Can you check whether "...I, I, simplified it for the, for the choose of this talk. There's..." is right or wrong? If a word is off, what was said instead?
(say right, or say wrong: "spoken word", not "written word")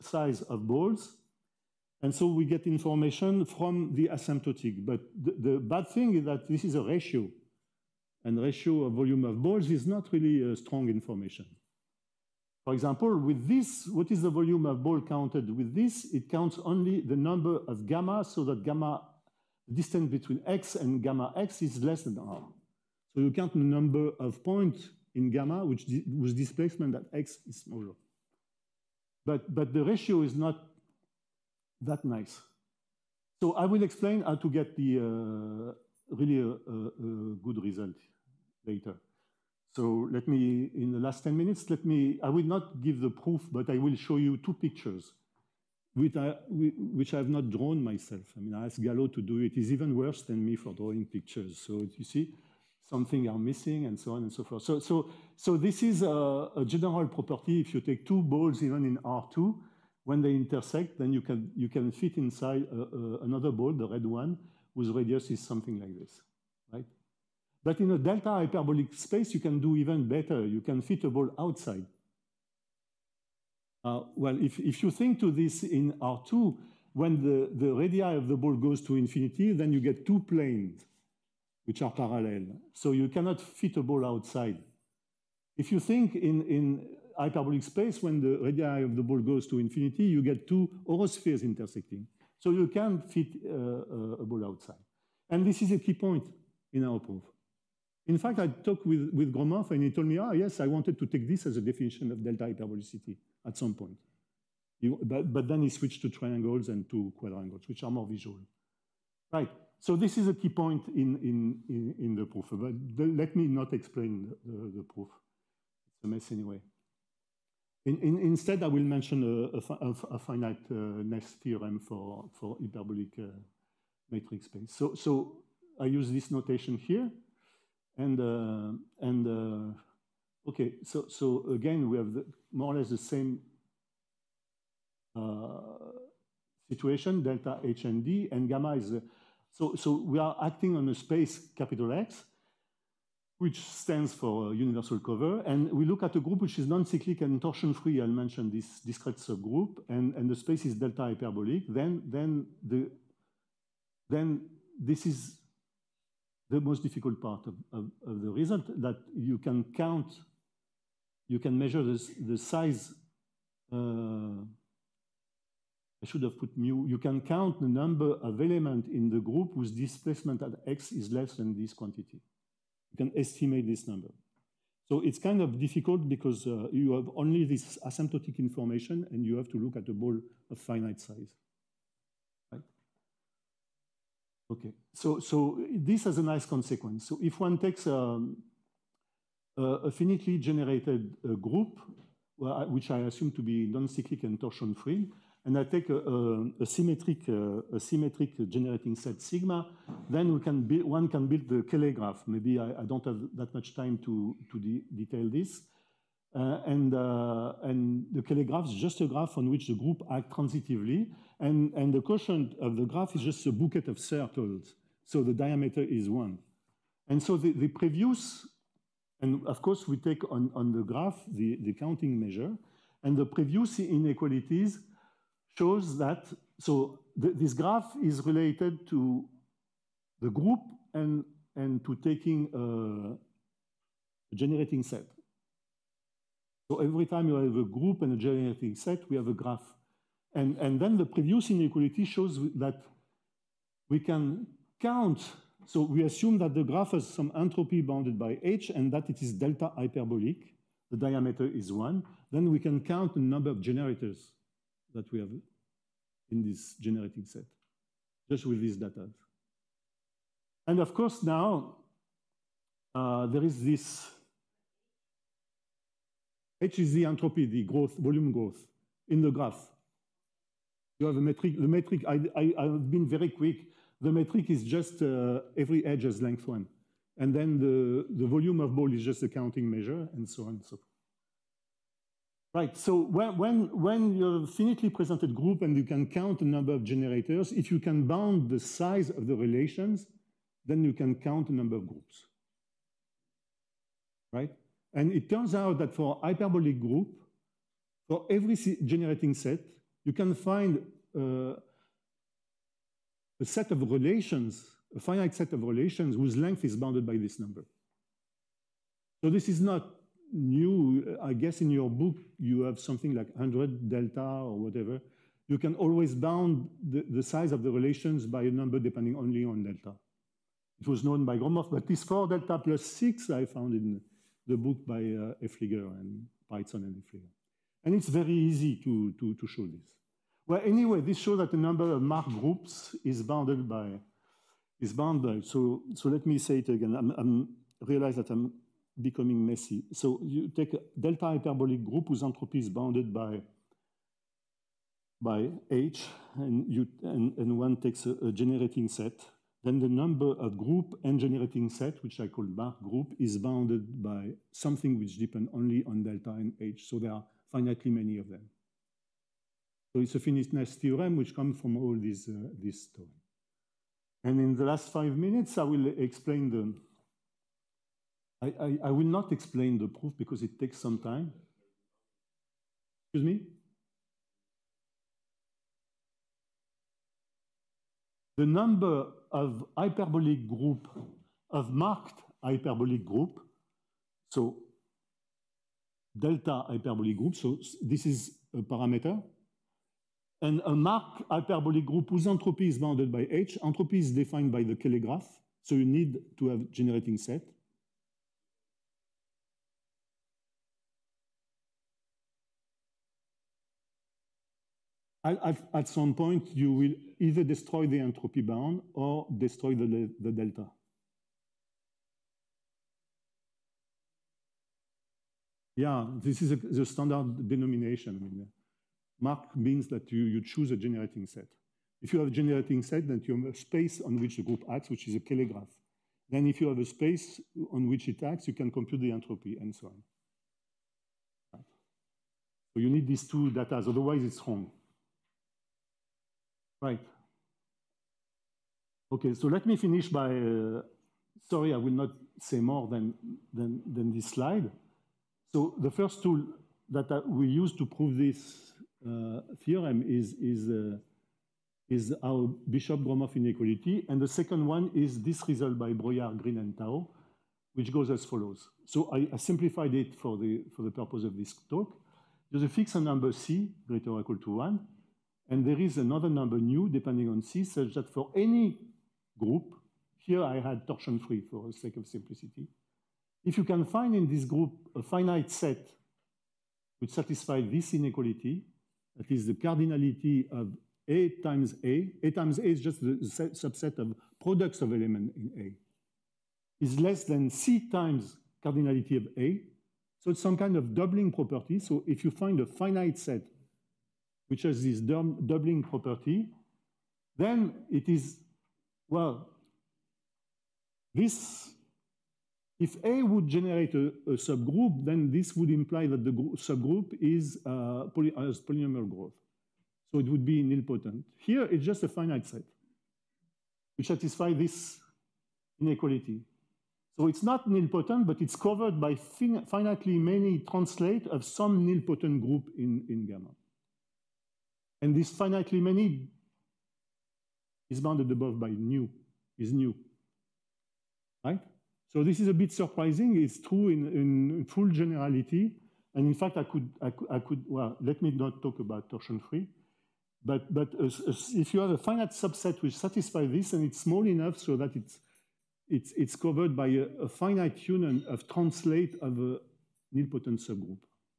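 wrong: "purpose", not "choose".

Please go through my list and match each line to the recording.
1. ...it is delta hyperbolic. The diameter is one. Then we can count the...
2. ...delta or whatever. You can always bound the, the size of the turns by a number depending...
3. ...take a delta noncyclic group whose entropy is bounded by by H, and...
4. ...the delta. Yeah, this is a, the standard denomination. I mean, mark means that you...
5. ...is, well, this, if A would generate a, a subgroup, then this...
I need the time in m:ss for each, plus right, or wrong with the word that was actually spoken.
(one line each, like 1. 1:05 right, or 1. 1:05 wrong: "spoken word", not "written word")
1. 4:09 right
2. 5:13 wrong: "relations", not "turns"
3. 5:40 wrong: "hyperbolic", not "noncyclic"
4. 6:50 right
5. 8:18 right.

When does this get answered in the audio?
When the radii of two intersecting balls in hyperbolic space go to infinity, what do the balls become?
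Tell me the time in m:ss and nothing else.
1:30.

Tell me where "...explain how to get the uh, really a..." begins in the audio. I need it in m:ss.
0:33.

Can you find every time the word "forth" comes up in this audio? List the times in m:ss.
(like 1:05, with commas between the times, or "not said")
0:54, 4:40.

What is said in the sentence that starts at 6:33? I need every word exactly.
Entropy is defined by the Cayley graph, so you need to have generating set.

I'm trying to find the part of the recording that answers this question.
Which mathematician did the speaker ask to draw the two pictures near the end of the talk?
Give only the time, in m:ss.
0:48.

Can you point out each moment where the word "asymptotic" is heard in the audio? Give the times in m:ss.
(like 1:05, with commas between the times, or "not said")
0:04, 2:57.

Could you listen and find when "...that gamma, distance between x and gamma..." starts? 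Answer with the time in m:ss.
0:18.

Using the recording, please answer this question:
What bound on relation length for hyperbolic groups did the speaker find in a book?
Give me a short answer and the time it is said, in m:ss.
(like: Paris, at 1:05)
4 delta plus 6, at 5:22.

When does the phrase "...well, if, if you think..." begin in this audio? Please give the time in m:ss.
1:14.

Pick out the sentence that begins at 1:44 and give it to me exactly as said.
You, but, but then he switched to triangles and to quadrangles, which are more visual.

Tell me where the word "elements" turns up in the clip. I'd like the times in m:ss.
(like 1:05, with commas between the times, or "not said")
2:48, 8:04.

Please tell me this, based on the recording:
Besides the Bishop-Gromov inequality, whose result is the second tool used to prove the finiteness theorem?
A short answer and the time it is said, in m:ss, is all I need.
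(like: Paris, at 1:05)
Breuillard, Green, and Tao, at 7:35.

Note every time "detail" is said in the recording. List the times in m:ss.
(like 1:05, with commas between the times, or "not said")
3:24.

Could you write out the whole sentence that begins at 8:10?
So it's some kind of doubling property.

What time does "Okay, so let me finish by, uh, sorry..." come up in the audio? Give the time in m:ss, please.
7:19.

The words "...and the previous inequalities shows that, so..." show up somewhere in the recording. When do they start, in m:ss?
3:43.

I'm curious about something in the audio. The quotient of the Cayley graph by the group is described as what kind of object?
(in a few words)
A bouquet of circles.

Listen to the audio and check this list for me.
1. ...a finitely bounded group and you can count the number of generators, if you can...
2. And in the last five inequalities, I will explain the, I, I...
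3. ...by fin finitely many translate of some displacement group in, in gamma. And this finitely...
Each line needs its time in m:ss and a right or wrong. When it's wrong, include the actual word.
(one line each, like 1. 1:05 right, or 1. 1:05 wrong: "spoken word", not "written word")
1. 4:44 wrong: "presented", not "bounded"
2. 6:04 wrong: "minutes", not "inequalities"
3. 8:38 wrong: "nilpotent", not "displacement".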